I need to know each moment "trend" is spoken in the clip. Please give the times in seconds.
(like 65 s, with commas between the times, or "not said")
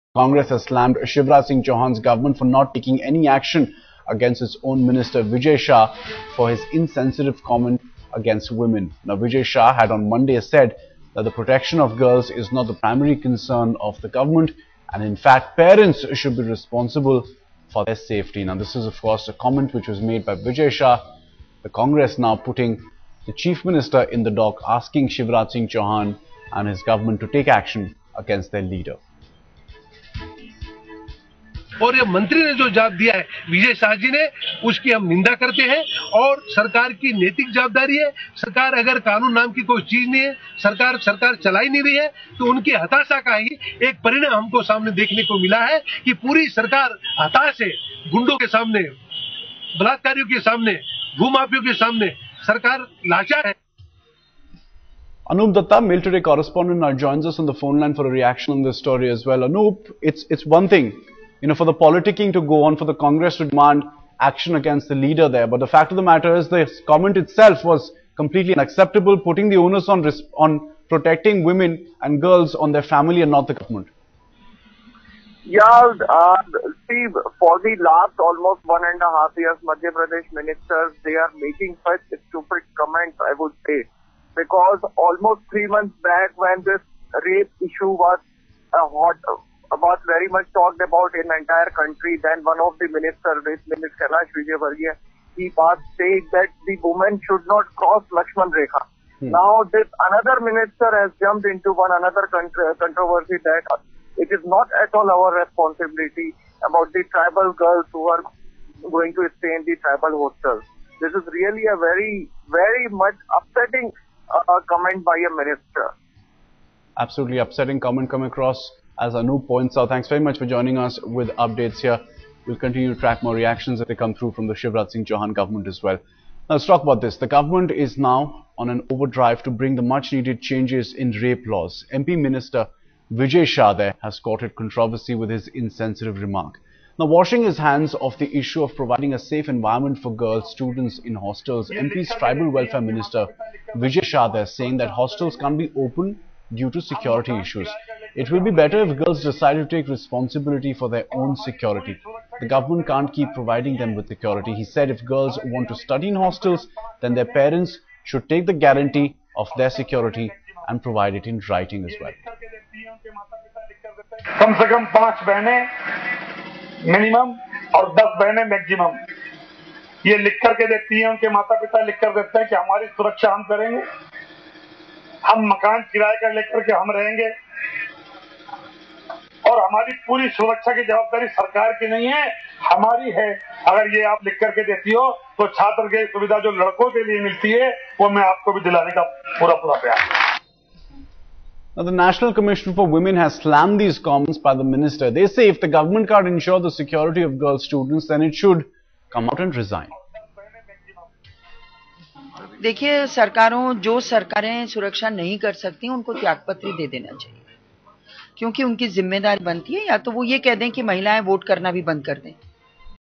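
not said.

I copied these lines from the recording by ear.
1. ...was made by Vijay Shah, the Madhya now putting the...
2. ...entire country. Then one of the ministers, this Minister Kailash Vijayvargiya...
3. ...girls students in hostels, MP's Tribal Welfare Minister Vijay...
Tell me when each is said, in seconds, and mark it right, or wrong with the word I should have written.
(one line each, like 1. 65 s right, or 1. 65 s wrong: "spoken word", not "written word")
1. 19 s wrong: "Congress", not "Madhya"
2. 91 s right
3. 140 s right.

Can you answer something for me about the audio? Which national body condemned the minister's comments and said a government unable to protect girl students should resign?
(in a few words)
National Commission for Women.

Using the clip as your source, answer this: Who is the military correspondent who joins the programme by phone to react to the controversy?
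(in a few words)
Anoop Datta.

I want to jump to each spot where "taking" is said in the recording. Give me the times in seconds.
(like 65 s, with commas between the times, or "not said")
2 s.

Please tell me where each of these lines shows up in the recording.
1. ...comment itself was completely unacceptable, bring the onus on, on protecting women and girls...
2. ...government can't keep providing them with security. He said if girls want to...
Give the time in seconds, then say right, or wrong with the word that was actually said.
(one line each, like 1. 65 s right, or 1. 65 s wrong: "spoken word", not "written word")
1. 66 s wrong: "putting", not "bring"
2. 152 s right.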